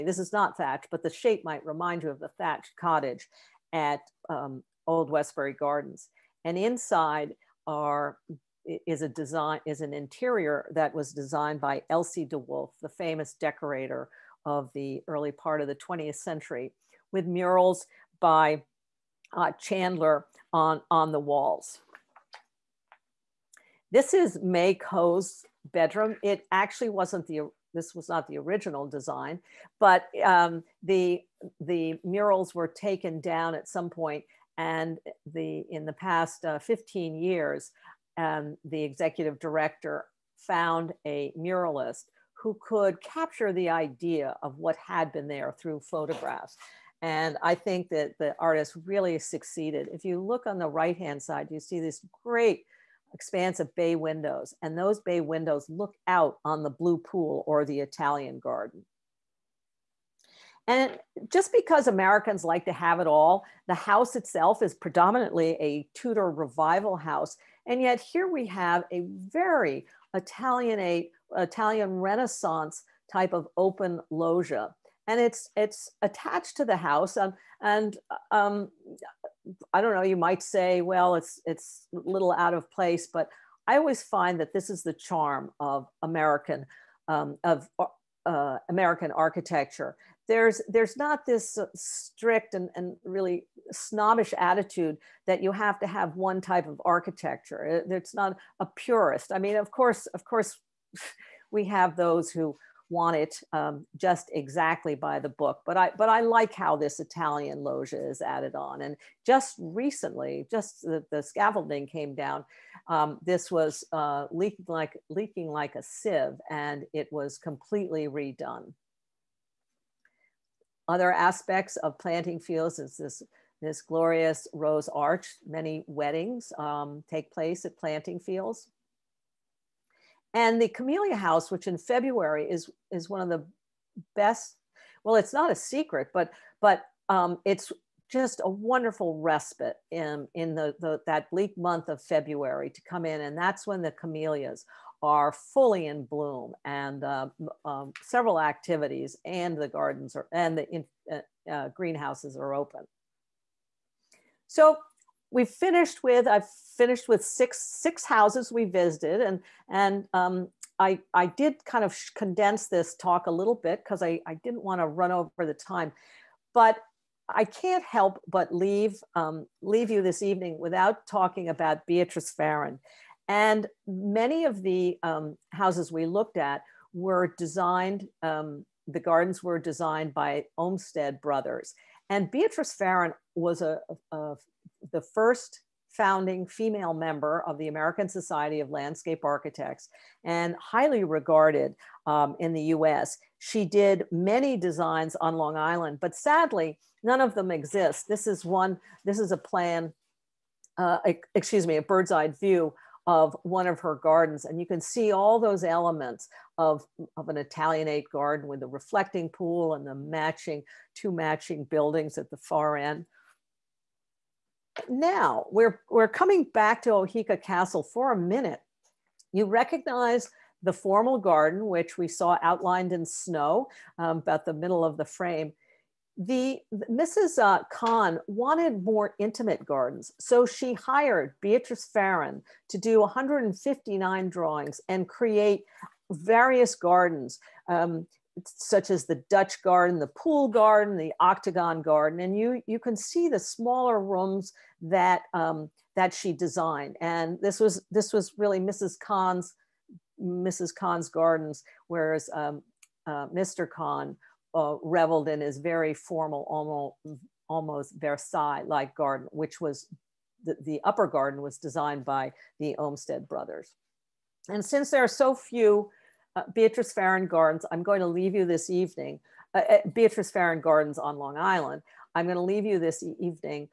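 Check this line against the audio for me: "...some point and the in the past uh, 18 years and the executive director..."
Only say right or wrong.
wrong.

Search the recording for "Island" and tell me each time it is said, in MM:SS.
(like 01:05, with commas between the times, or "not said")
03:15, 04:31.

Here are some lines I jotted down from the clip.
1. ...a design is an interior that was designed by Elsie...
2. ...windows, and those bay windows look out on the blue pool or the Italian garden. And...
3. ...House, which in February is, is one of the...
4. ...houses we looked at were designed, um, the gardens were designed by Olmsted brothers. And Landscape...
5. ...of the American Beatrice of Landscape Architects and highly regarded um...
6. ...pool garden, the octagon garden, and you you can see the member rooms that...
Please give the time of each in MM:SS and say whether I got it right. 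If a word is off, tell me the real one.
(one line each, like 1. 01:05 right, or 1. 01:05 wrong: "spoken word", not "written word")
1. 00:09 right
2. 00:53 right
3. 02:11 right
4. 02:55 wrong: "Beatrice", not "Landscape"
5. 03:07 wrong: "Society", not "Beatrice"
6. 04:00 wrong: "smaller", not "member".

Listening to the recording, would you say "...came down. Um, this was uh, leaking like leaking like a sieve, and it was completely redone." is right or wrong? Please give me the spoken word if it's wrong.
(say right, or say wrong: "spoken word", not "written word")
right.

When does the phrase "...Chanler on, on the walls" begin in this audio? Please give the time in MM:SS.
00:19.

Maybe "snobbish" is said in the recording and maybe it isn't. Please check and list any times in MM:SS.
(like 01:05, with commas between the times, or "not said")
01:33.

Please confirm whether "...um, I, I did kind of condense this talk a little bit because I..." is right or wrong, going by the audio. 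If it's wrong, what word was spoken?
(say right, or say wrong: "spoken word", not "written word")
right.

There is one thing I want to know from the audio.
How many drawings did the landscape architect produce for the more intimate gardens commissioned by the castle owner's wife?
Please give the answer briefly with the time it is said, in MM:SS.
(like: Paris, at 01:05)
159, at 03:52.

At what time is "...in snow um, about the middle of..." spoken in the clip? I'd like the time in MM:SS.
03:42.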